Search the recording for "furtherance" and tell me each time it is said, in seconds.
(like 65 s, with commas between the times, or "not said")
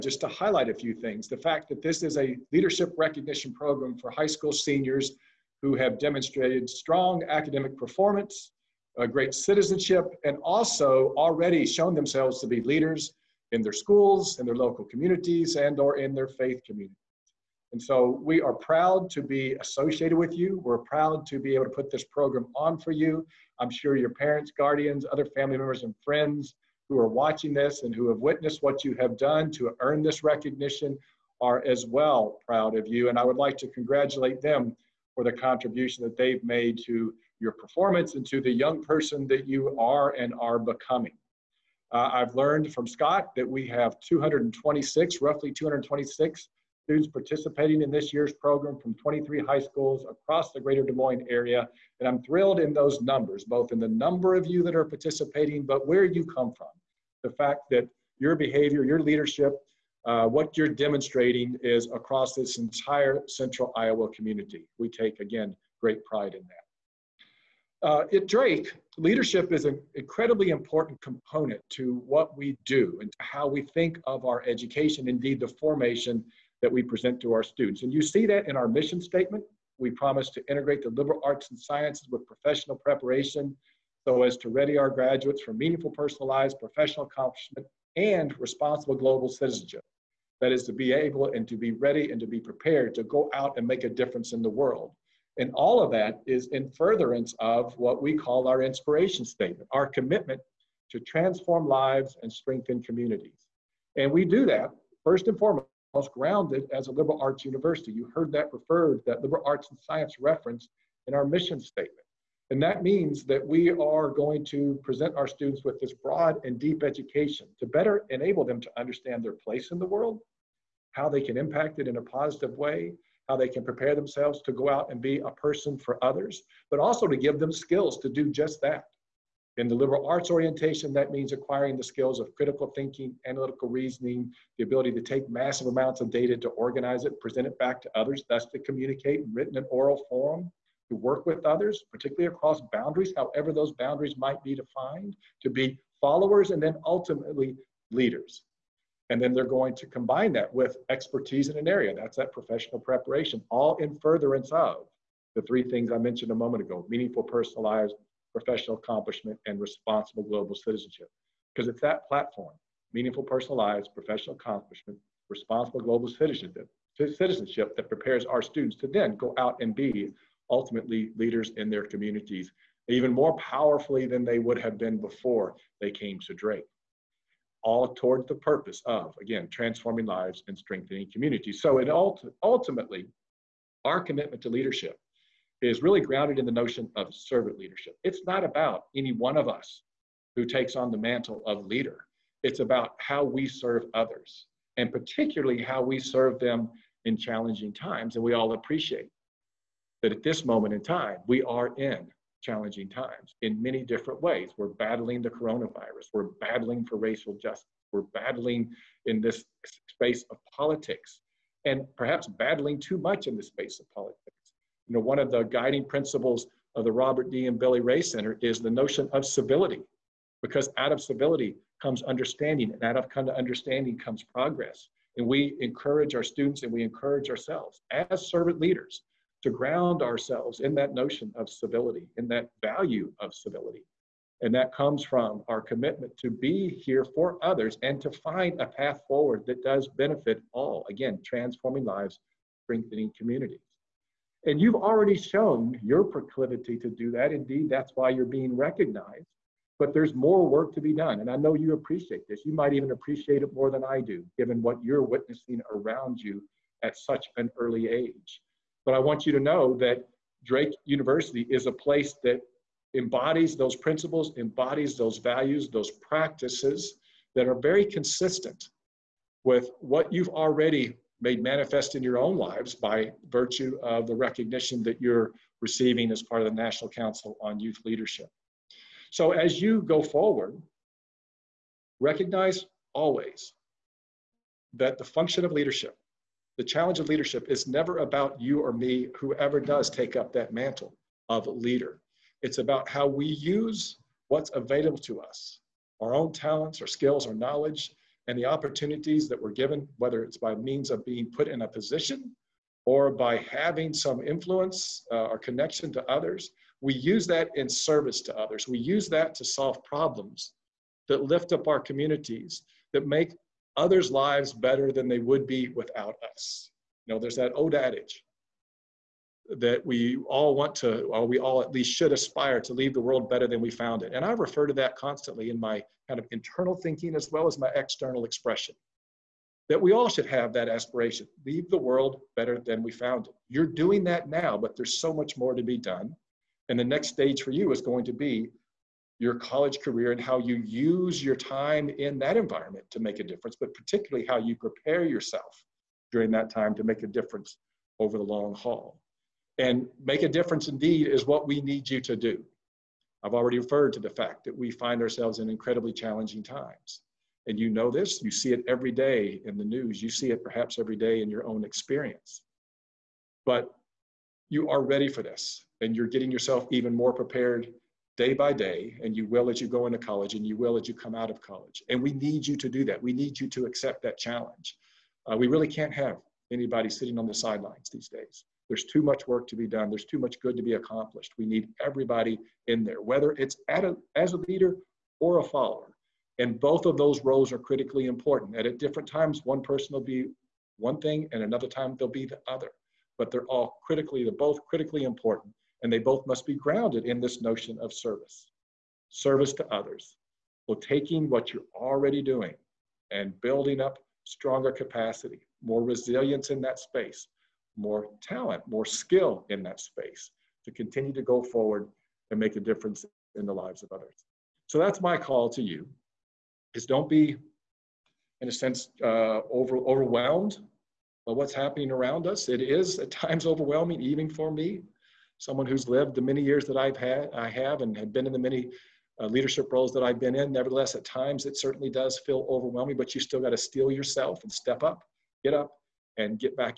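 96 s, 154 s.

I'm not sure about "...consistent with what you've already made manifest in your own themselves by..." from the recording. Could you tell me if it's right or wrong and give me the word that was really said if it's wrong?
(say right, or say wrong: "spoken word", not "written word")
wrong: "lives", not "themselves".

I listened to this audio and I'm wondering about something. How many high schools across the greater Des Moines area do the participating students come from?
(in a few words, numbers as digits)
23.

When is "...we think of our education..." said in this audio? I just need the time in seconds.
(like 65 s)
73 s.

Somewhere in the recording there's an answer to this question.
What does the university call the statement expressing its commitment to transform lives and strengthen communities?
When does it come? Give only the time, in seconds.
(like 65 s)
98 s.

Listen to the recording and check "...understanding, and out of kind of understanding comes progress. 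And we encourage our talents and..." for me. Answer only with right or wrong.
wrong.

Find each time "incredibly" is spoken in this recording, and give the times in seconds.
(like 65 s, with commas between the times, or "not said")
69 s, 355 s.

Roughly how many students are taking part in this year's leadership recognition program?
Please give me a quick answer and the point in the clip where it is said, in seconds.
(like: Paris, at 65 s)
226, at 45 s.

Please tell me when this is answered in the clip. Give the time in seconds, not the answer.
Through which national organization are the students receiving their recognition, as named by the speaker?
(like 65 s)
276 s.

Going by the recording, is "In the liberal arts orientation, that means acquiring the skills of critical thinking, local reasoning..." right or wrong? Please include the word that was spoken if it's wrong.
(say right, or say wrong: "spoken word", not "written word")
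wrong: "analytical", not "local".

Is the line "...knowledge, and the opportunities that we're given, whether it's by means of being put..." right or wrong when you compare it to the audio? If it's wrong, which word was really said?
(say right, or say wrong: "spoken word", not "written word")
right.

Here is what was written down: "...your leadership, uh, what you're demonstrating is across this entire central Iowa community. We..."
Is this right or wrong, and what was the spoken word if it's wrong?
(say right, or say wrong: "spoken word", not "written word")
right.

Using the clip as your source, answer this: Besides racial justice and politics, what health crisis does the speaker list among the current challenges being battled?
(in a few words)
coronavirus.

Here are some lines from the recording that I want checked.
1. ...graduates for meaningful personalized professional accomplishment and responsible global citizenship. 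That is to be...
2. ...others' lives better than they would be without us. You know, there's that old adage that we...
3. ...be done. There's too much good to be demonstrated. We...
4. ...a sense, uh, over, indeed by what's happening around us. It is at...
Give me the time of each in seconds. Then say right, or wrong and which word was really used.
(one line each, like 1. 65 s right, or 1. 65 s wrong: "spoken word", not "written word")
1. 84 s right
2. 313 s right
3. 379 s wrong: "accomplished", not "demonstrated"
4. 418 s wrong: "overwhelmed", not "indeed".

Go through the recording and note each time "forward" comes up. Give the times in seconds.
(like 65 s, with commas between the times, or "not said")
239 s, 280 s, 411 s.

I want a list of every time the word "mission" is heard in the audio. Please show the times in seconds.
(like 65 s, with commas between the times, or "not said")
78 s, 111 s.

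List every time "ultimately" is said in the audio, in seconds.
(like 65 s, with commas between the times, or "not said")
146 s, 170 s, 182 s.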